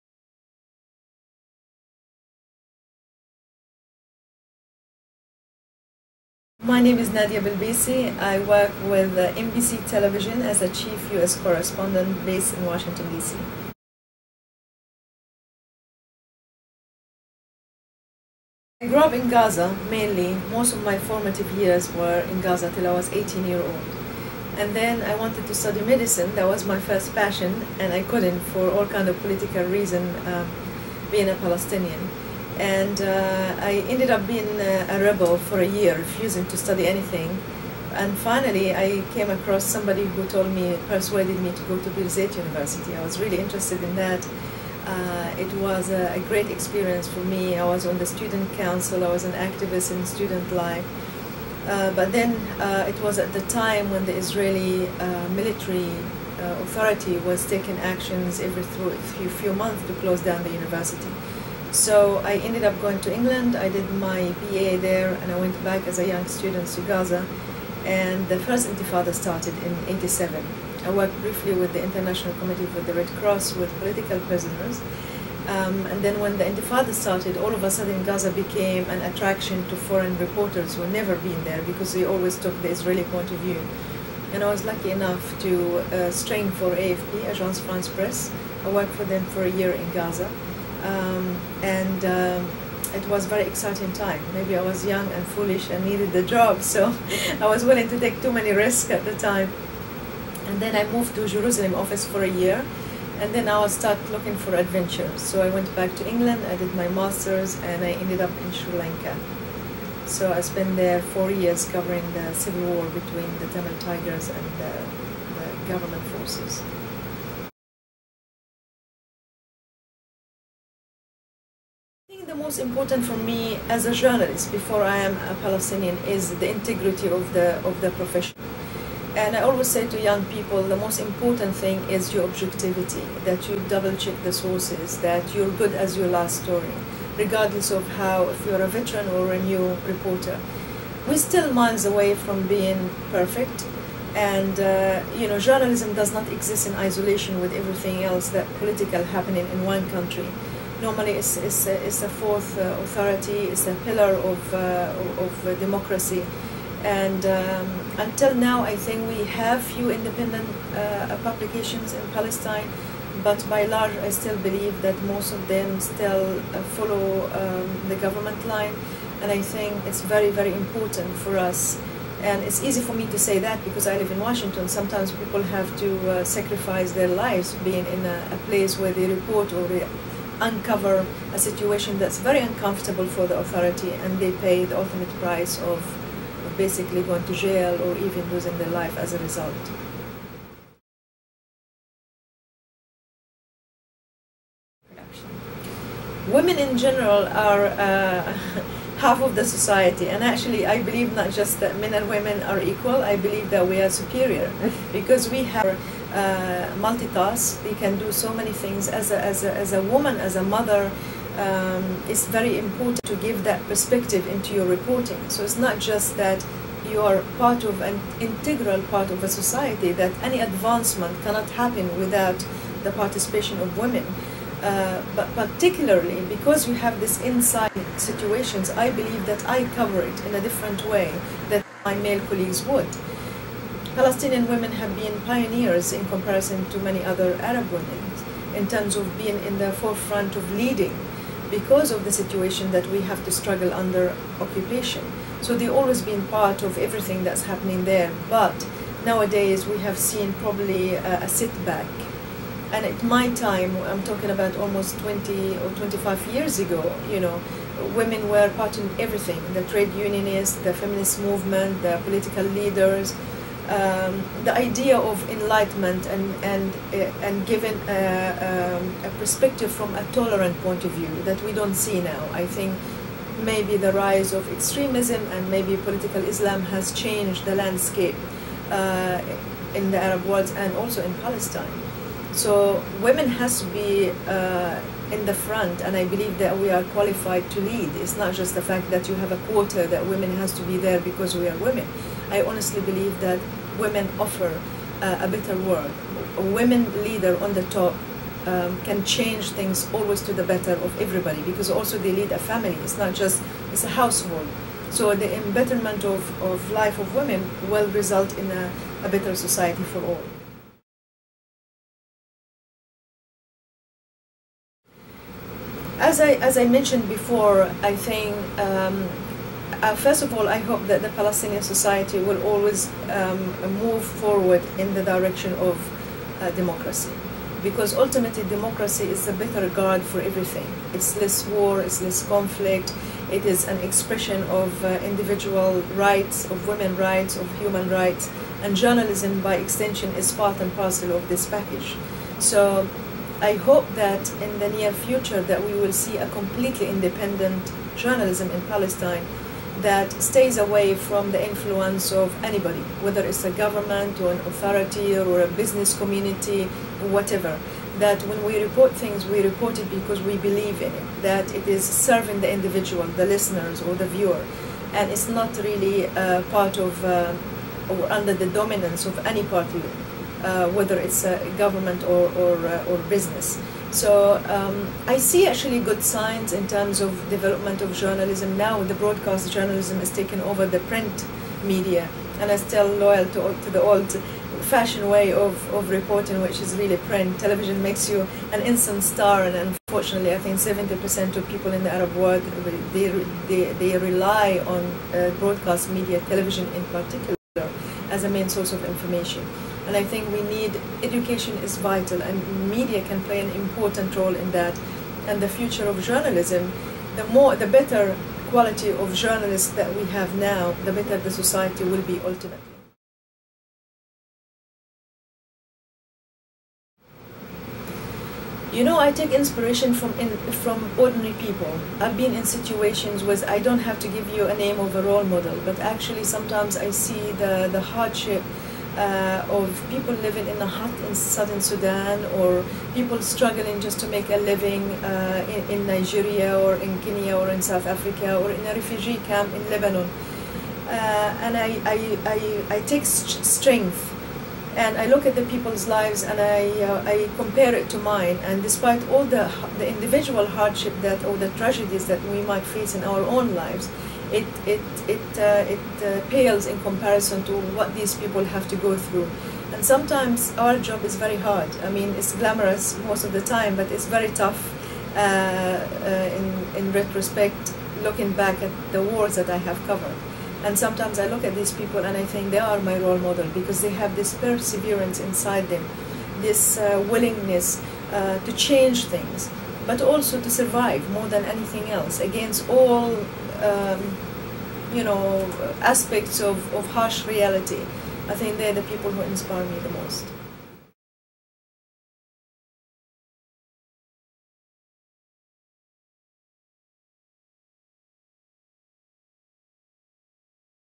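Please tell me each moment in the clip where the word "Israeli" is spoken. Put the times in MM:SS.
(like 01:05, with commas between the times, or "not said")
00:54, 01:22.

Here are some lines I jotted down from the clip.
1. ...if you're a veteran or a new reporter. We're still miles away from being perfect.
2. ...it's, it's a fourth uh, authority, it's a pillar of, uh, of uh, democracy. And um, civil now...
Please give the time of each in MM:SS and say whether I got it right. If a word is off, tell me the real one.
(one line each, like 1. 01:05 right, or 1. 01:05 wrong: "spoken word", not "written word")
1. 02:18 right
2. 02:31 wrong: "until", not "civil".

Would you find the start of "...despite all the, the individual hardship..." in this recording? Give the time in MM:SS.
07:28.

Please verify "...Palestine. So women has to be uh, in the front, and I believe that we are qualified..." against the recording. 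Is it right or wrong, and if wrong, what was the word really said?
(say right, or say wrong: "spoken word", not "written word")
right.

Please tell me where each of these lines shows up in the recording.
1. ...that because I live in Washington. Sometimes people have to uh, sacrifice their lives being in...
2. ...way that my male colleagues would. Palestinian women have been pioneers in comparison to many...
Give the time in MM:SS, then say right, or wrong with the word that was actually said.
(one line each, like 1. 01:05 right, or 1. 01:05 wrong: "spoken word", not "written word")
1. 02:53 right
2. 03:50 right.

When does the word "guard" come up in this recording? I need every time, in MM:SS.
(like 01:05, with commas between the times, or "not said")
05:29.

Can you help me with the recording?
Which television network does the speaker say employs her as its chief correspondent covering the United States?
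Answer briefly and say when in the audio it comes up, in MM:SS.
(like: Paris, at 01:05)
MBC Television, at 00:09.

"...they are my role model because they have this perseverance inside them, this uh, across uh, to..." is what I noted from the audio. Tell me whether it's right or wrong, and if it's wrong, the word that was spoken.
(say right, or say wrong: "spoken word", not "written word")
wrong: "willingness", not "across".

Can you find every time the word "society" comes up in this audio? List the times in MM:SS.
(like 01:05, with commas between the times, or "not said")
03:19, 03:39, 05:09, 05:21, 06:51.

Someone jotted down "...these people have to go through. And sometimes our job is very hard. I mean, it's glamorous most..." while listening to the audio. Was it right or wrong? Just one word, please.
right.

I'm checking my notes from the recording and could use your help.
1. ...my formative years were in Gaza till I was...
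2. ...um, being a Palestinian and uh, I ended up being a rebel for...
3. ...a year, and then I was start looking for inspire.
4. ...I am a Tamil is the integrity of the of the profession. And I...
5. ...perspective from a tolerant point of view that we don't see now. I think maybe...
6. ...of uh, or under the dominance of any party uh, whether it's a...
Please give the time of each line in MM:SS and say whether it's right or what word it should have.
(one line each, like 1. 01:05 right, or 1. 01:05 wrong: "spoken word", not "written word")
1. 00:20 right
2. 00:30 right
3. 01:42 wrong: "adventure", not "inspire"
4. 02:04 wrong: "Palestinian", not "Tamil"
5. 04:29 right
6. 06:06 right.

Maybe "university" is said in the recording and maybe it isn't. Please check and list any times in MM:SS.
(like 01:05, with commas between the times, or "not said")
00:42, 01:00.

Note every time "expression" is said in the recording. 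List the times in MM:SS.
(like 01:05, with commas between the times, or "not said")
05:33.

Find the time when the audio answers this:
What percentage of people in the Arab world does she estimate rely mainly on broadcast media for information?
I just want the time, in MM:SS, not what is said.
06:30.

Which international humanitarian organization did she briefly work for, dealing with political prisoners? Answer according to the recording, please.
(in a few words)
International Committee for the Red Cross.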